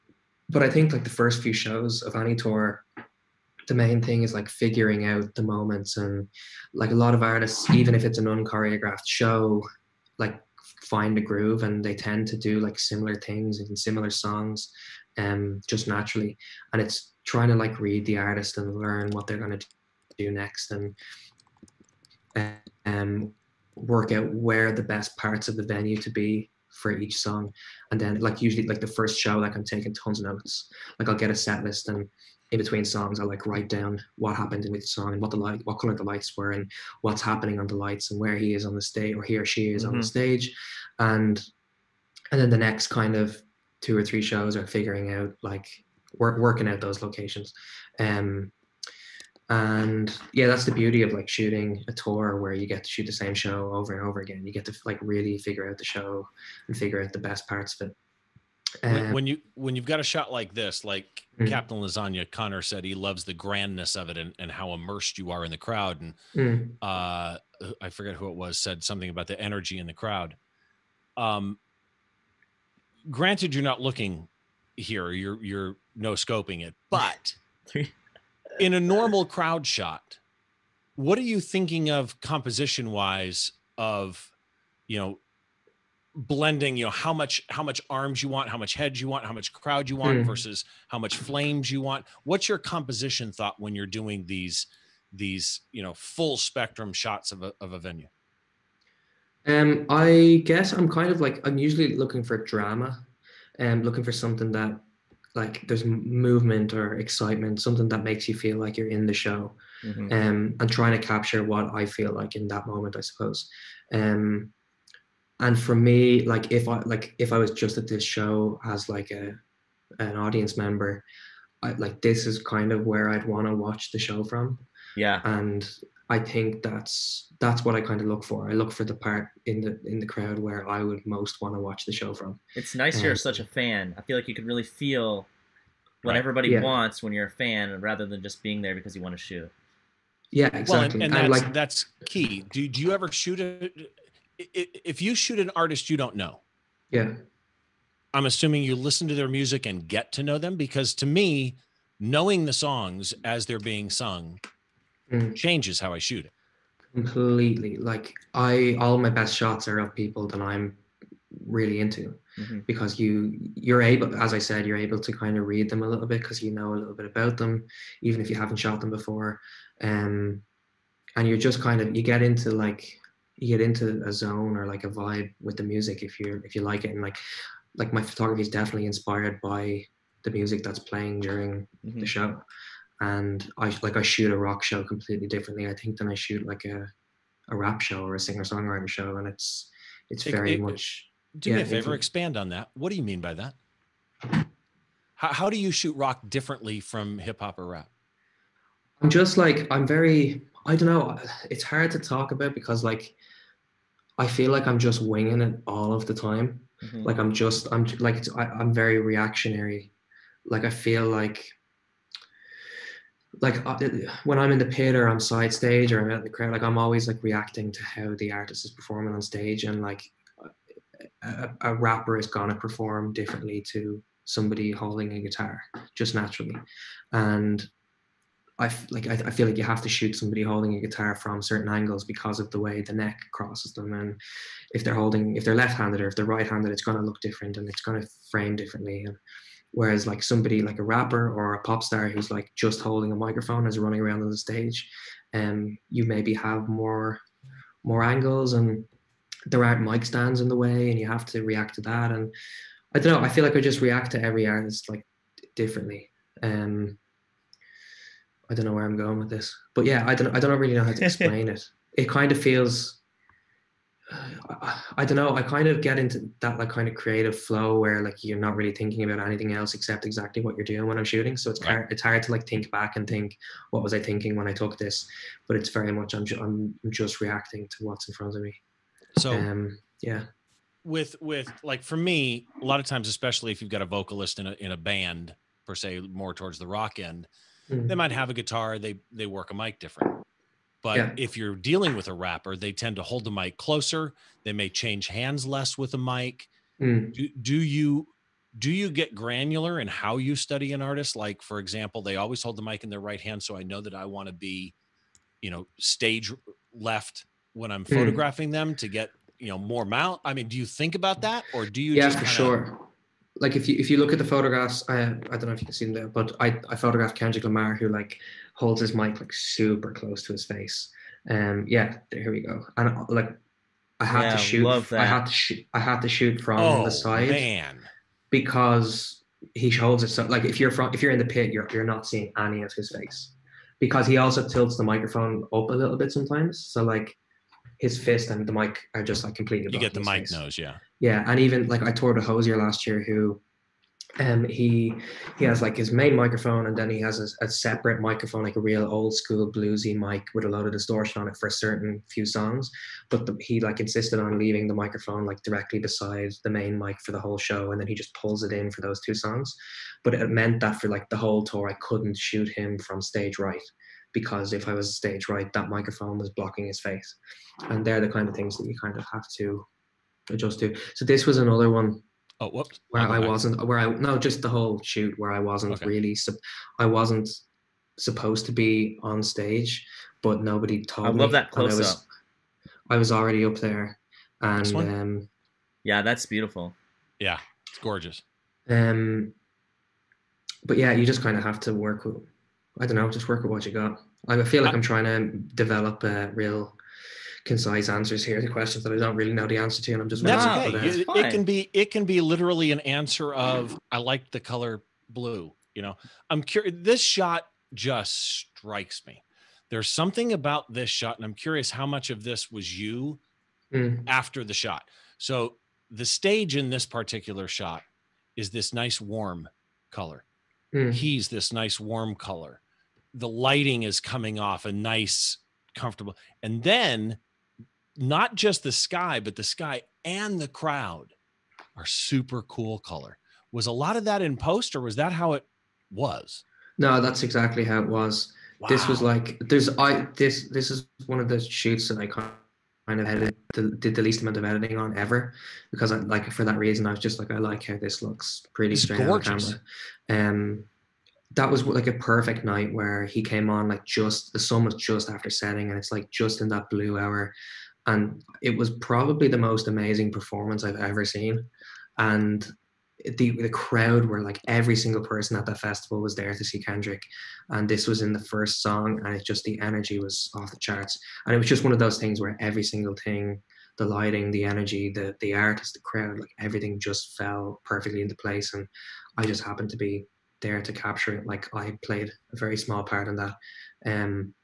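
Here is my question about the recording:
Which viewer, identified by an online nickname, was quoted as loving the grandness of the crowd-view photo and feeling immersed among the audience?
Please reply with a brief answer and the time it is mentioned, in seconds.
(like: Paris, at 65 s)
Captain Lasagna Connor, at 61 s.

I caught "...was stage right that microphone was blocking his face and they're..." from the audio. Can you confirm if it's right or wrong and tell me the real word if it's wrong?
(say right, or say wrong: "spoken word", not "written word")
right.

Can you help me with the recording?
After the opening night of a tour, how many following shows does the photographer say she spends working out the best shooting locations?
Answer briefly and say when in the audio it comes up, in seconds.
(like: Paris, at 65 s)
2 or 3, at 43 s.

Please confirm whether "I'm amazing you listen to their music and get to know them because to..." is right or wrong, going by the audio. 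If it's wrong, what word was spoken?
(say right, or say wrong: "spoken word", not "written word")
wrong: "assuming", not "amazing".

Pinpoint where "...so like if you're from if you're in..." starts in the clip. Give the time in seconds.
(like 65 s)
330 s.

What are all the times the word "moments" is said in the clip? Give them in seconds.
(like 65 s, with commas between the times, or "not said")
5 s, 112 s.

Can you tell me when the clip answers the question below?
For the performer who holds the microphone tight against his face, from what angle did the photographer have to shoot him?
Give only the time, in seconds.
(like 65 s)
326 s.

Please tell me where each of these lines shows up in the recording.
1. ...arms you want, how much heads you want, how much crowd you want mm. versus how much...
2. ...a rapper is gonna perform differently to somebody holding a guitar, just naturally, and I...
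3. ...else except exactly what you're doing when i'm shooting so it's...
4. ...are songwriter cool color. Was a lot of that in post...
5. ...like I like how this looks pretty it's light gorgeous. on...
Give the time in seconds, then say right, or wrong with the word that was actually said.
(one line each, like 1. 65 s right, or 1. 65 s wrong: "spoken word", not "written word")
1. 87 s right
2. 221 s right
3. 269 s right
4. 431 s wrong: "super", not "songwriter"
5. 447 s wrong: "straight", not "light".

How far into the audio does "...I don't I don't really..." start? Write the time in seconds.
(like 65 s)
260 s.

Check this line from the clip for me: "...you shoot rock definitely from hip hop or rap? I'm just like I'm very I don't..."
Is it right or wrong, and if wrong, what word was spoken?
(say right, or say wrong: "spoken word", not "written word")
wrong: "differently", not "definitely".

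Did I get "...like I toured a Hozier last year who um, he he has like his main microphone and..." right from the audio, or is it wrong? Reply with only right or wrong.
right.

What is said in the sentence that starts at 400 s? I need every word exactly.
It, it, can be it can be literally an answer of I like the color blue.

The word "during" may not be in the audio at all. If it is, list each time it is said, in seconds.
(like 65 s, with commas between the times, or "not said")
181 s.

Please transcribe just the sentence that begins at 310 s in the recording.
I mean, do you think about that, or do you?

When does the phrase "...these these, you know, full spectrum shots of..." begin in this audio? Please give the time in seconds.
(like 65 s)
94 s.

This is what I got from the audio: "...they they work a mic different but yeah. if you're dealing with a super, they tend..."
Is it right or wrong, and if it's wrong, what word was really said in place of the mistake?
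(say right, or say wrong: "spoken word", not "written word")
wrong: "rapper", not "super".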